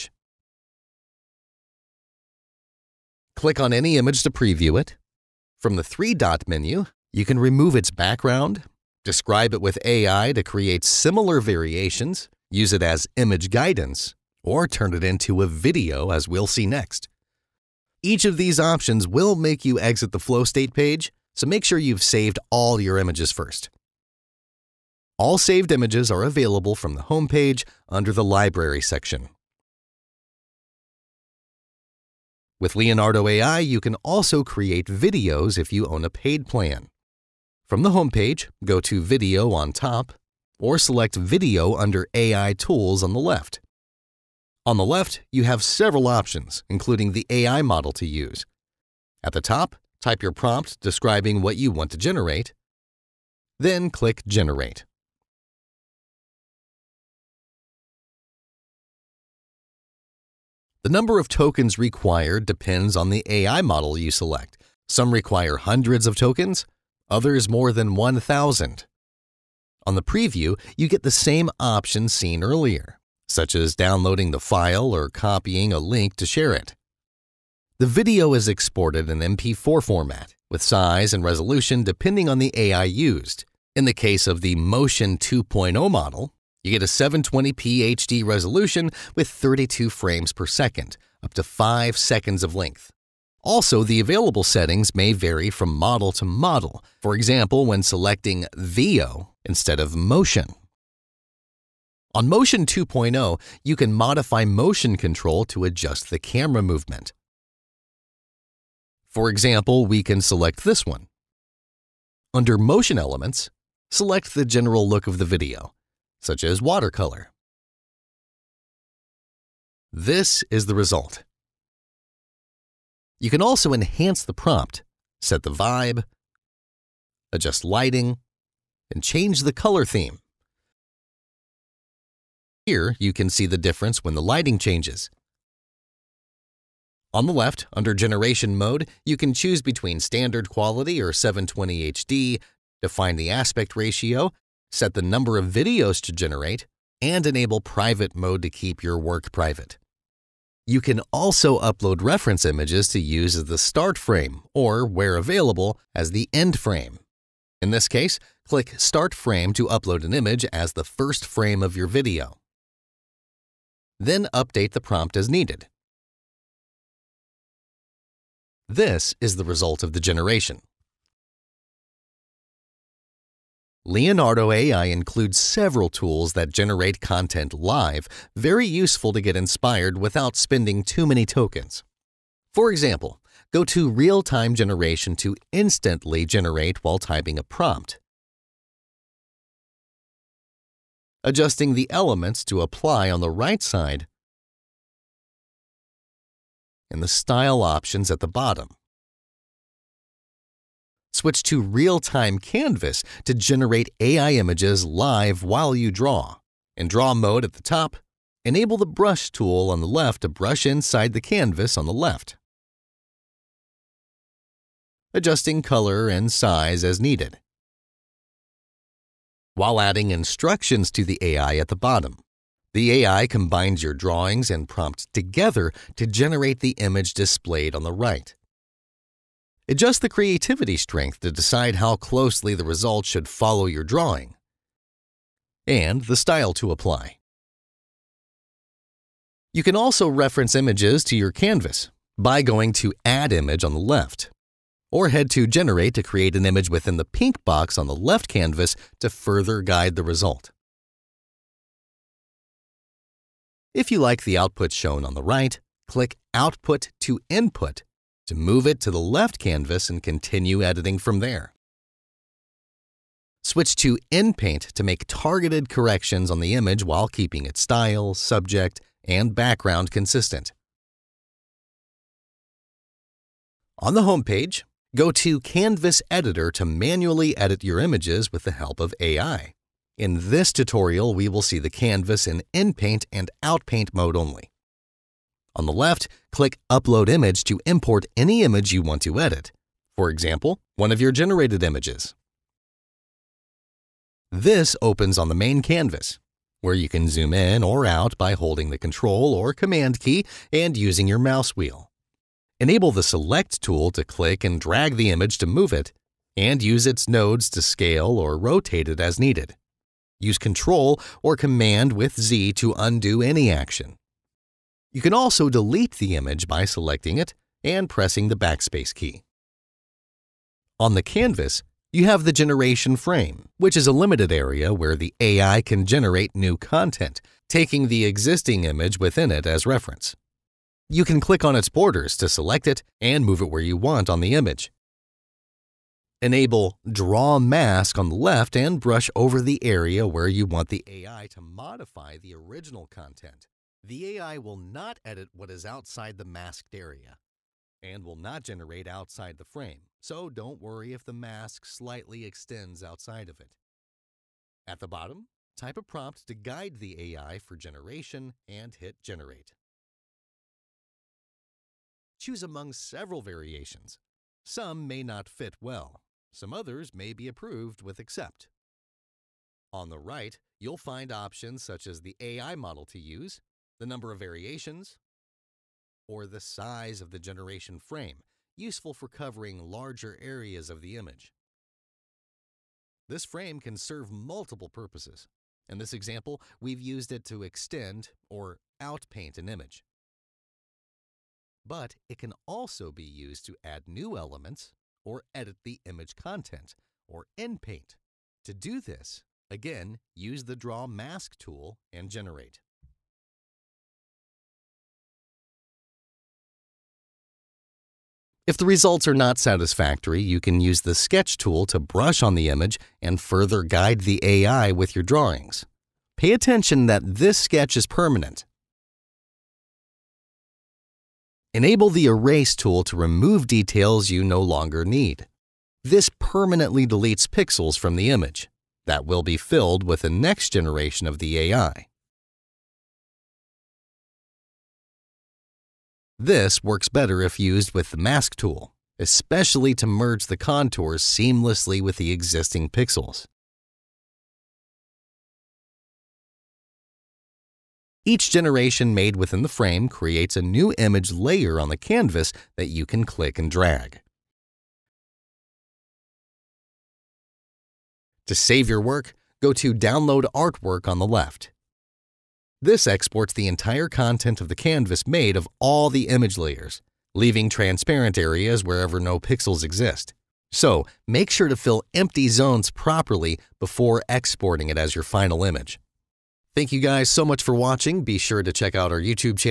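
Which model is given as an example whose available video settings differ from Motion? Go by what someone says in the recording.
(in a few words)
Veo.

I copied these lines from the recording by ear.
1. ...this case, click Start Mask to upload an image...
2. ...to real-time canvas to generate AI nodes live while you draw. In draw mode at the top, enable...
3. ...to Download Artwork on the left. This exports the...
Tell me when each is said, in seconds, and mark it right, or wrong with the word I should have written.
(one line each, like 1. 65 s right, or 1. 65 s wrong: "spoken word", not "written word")
1. 157 s wrong: "Frame", not "Mask"
2. 201 s wrong: "images", not "nodes"
3. 459 s right.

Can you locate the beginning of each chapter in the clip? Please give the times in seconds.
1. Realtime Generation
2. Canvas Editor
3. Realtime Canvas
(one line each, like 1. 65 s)
1. 173 s
2. 273 s
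3. 200 s.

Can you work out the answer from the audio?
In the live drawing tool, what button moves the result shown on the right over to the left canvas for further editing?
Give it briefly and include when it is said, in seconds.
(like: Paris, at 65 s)
Output to Input, at 256 s.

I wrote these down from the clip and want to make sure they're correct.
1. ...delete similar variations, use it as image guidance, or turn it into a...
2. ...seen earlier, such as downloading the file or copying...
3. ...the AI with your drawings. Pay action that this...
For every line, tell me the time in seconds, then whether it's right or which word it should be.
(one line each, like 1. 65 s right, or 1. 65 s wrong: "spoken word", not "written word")
1. 10 s wrong: "create", not "delete"
2. 72 s right
3. 414 s wrong: "attention", not "action".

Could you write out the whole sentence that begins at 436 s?
This works better if used with the Mask tool, especially to merge the contours seamlessly with the existing pixels.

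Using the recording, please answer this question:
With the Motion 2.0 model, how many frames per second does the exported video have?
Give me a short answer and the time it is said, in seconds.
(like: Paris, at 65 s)
32, at 89 s.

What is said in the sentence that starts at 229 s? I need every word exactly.
Adjust the creativity strength to decide how closely the result should follow your drawing, and the style to apply.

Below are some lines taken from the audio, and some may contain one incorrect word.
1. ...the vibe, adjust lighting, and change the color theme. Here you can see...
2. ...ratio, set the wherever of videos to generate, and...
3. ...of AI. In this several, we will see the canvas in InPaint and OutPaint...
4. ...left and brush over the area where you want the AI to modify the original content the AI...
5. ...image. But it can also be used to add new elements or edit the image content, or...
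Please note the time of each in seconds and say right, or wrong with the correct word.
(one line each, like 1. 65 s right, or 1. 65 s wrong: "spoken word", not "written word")
1. 125 s right
2. 143 s wrong: "number", not "wherever"
3. 278 s wrong: "tutorial", not "several"
4. 338 s right
5. 389 s right.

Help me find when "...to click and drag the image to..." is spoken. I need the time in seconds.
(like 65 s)
303 s.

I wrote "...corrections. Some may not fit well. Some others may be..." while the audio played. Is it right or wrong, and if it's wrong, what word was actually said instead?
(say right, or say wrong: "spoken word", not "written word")
wrong: "variations", not "corrections".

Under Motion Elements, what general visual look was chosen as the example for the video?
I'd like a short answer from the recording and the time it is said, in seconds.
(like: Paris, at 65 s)
watercolor, at 116 s.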